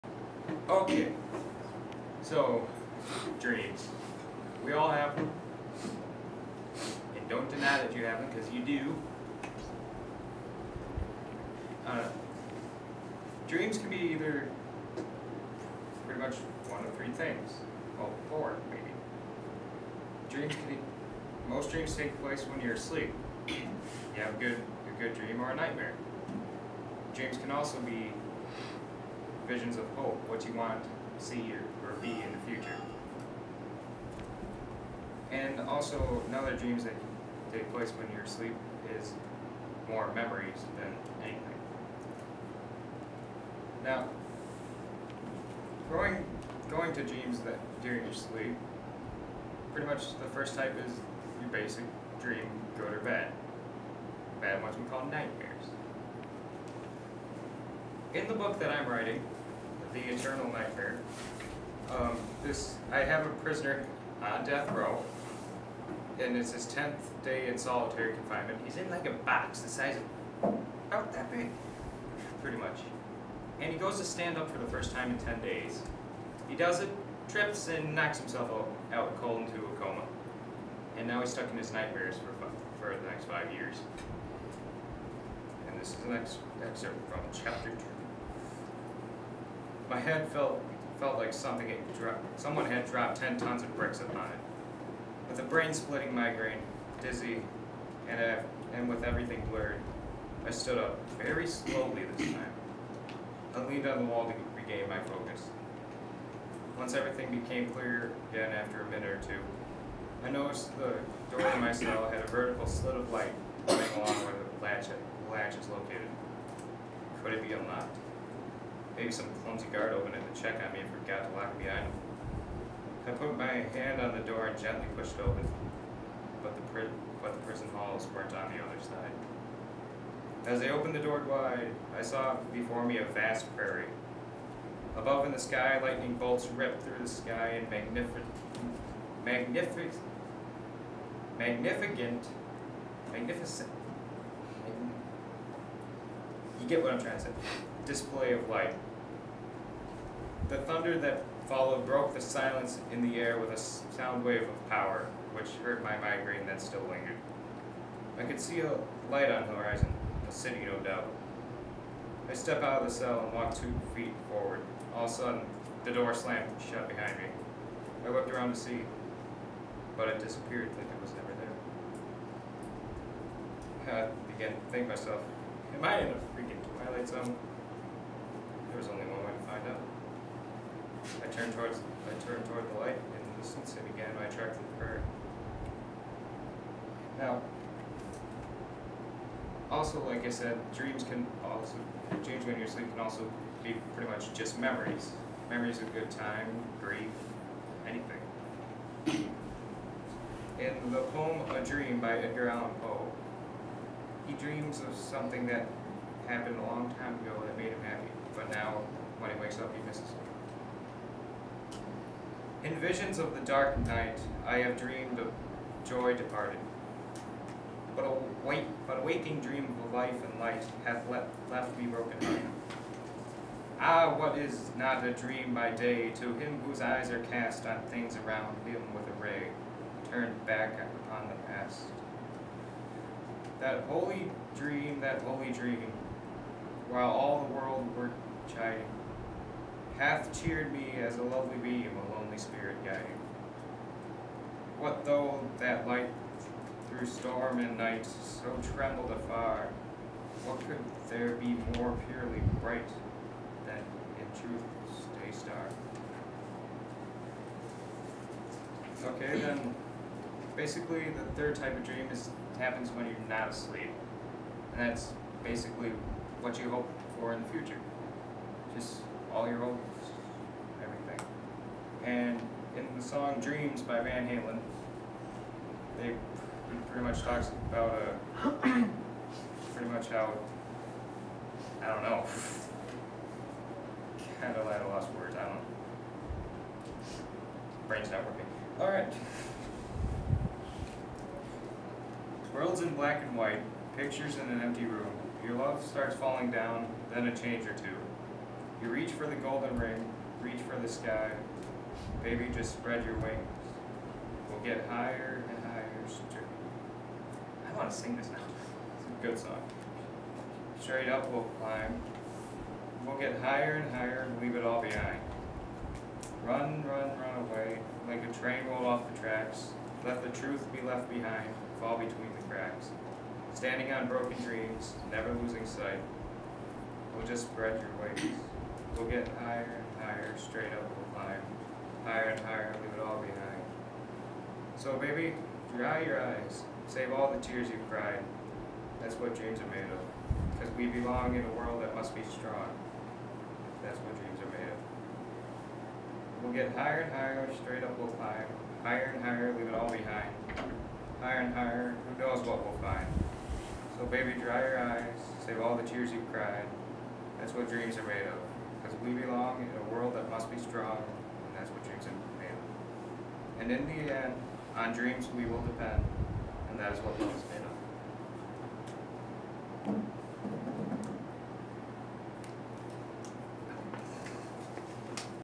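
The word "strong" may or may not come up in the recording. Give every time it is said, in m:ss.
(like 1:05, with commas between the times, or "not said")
5:42, 6:00.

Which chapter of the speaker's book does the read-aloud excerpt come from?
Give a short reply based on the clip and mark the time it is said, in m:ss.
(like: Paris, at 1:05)
Chapter 2, at 1:27.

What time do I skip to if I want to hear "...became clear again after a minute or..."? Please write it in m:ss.
1:47.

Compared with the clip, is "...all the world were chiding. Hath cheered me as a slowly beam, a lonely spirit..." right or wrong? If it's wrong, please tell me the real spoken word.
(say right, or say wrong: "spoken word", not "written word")
wrong: "lovely", not "slowly".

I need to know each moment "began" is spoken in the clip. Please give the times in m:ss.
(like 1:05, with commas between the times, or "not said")
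2:54, 3:03.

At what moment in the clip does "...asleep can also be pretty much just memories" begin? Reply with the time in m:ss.
3:12.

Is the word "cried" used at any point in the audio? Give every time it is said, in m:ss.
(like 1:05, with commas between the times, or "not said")
5:37, 5:56.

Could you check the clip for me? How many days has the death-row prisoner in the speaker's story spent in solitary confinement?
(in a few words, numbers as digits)
10.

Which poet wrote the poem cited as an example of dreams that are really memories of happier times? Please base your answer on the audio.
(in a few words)
Edgar Allan Poe.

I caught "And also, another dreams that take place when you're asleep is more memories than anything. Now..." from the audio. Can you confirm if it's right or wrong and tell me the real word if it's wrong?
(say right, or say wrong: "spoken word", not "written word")
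right.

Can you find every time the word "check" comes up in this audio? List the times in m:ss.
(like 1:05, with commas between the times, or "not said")
2:00.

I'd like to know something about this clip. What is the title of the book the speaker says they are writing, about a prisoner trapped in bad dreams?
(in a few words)
The Eternal Nightmare.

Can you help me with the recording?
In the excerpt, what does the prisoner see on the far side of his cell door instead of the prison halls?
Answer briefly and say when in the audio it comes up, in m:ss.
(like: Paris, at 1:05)
A vast prairie, at 2:12.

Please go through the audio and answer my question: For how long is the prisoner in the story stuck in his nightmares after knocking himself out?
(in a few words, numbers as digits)
5 years.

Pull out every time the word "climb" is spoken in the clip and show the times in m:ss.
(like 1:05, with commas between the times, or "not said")
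5:11, 5:31, 5:48.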